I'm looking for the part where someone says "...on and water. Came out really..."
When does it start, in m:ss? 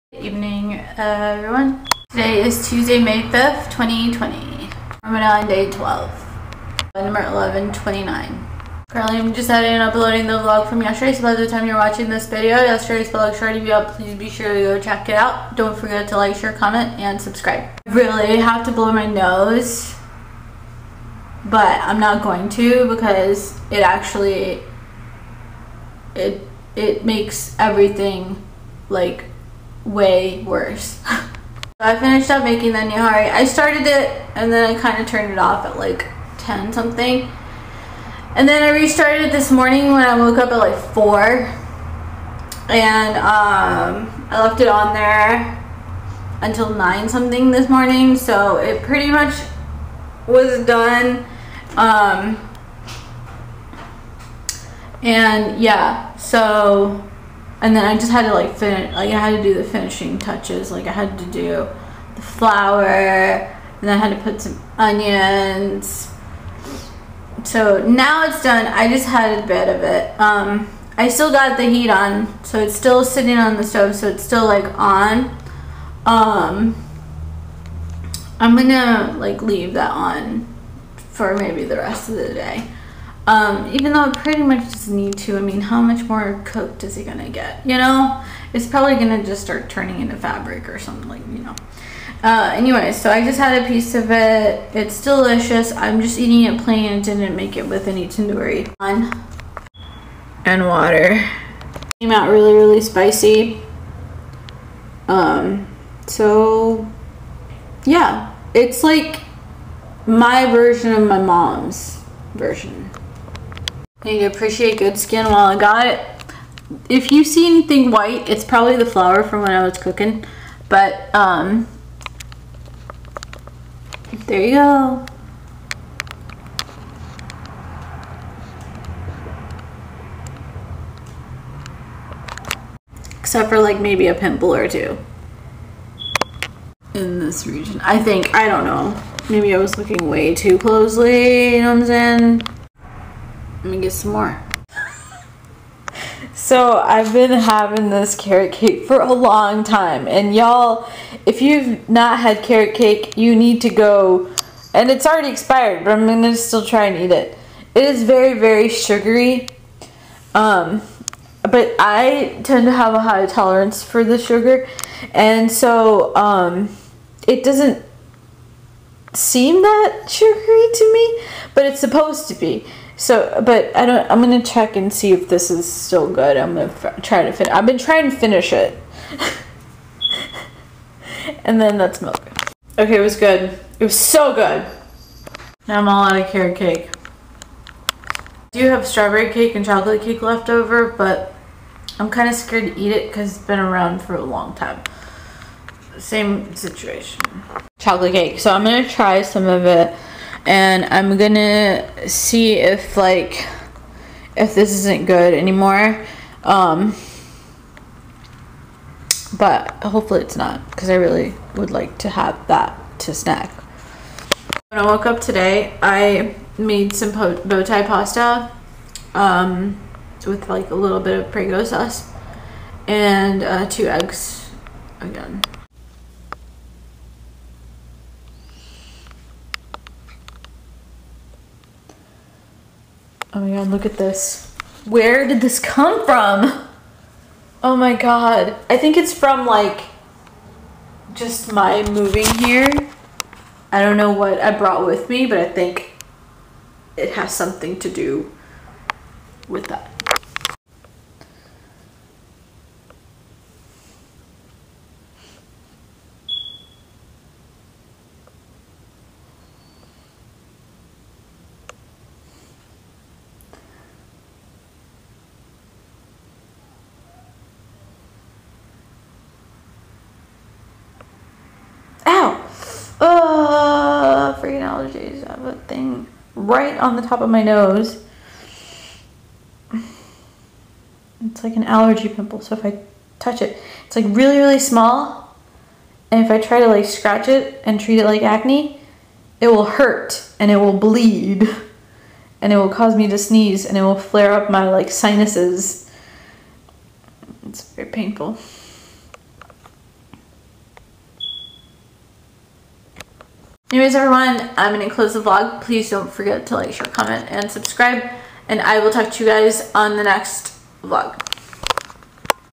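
1:38.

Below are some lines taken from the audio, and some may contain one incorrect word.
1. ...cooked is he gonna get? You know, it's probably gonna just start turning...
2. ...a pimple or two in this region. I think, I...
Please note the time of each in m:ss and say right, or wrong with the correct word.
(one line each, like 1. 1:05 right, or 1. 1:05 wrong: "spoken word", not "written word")
1. 1:26 right
2. 2:14 right.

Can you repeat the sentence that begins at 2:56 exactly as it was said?
I'm gonna f- try to finish.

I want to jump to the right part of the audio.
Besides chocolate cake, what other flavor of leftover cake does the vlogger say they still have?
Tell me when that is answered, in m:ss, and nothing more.
3:08.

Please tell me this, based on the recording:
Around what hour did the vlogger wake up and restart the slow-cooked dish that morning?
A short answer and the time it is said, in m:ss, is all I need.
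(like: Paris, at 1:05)
4, at 0:40.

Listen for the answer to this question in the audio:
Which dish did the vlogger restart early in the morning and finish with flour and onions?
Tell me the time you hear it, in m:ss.
0:32.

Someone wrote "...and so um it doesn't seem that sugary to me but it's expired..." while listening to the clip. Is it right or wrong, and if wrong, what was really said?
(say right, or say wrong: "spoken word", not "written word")
wrong: "supposed", not "expired".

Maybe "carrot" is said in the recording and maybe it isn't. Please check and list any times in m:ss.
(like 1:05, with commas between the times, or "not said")
2:28, 2:32, 3:06.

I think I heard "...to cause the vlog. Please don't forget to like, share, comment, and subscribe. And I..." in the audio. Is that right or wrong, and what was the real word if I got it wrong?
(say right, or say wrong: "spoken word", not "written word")
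wrong: "close", not "cause".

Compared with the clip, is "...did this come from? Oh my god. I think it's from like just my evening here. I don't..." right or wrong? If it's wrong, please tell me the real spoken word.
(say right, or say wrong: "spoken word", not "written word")
wrong: "moving", not "evening".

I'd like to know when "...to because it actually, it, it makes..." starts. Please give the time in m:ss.
0:22.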